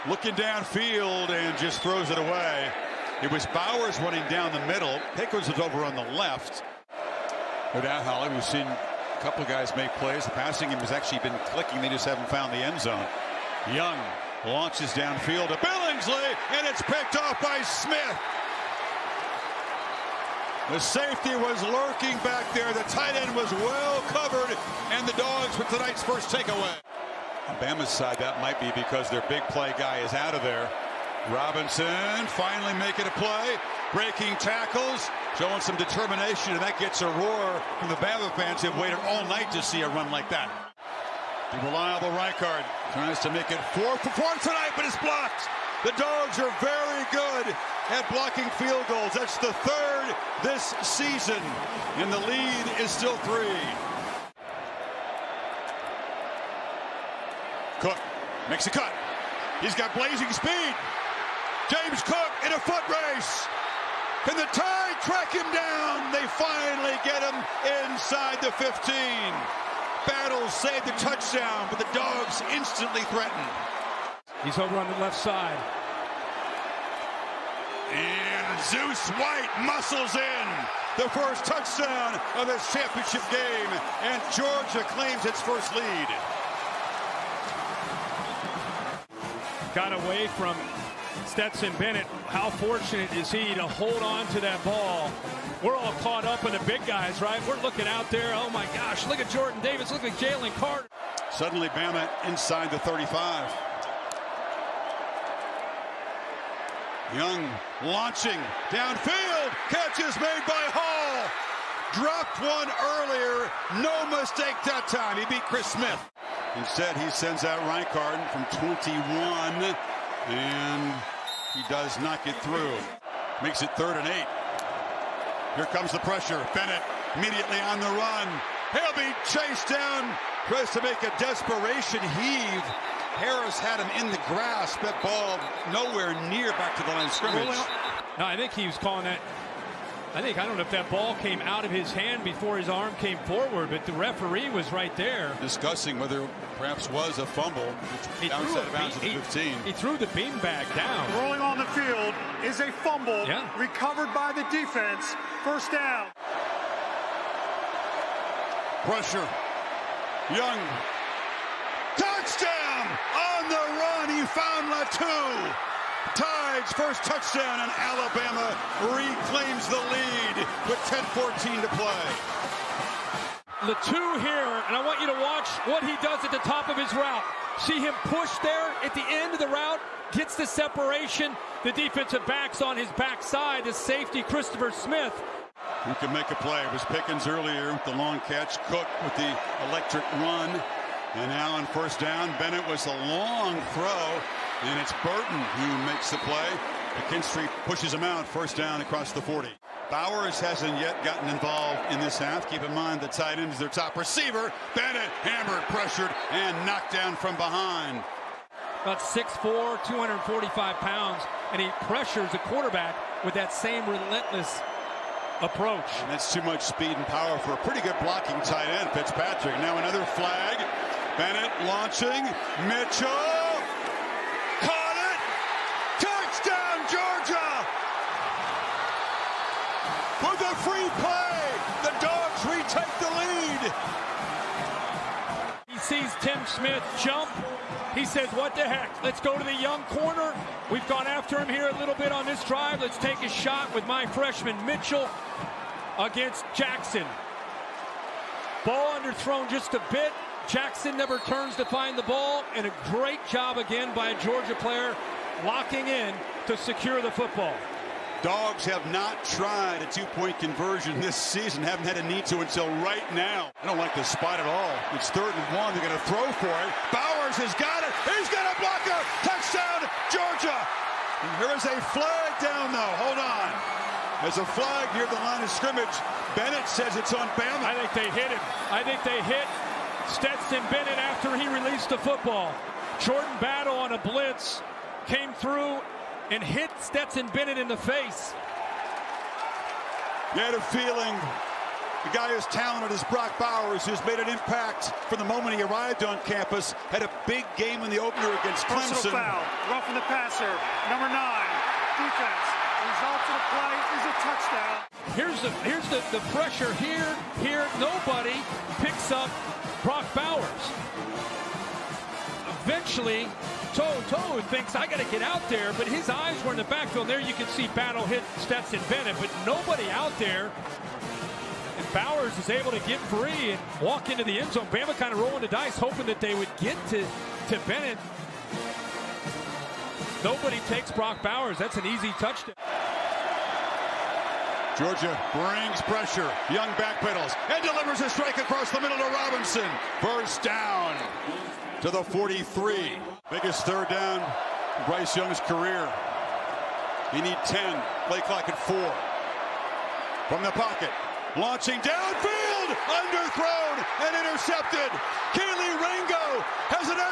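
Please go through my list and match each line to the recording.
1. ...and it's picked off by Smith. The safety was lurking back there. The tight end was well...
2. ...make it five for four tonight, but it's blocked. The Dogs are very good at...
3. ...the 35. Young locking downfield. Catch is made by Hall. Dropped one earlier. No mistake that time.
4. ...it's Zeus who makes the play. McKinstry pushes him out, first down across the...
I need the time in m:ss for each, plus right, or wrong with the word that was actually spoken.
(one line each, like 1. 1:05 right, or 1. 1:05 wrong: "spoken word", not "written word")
1. 0:16 right
2. 0:43 wrong: "four", not "five"
3. 1:42 wrong: "launching", not "locking"
4. 3:14 wrong: "Burton", not "Zeus".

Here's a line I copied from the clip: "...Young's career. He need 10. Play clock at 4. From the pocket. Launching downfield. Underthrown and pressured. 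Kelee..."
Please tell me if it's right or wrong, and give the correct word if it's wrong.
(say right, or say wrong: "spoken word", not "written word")
wrong: "intercepted", not "pressured".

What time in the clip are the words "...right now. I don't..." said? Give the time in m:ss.
4:22.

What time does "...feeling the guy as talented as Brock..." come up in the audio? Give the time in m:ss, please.
4:50.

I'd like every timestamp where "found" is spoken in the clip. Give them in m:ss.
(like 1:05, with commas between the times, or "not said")
0:12, 2:44.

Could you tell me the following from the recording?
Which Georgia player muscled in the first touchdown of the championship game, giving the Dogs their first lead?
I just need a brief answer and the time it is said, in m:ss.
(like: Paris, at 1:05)
Zeus White, at 1:18.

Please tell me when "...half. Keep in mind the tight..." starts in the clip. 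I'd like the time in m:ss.
3:22.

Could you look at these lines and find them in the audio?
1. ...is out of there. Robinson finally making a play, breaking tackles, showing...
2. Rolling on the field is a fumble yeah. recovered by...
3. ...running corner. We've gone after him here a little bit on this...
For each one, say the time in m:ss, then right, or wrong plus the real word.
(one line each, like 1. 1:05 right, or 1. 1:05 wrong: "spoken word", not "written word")
1. 0:29 right
2. 2:31 right
3. 3:59 wrong: "young", not "running".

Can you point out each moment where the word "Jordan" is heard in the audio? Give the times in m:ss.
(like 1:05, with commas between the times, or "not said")
1:39, 4:43.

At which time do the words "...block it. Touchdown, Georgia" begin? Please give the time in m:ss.
4:28.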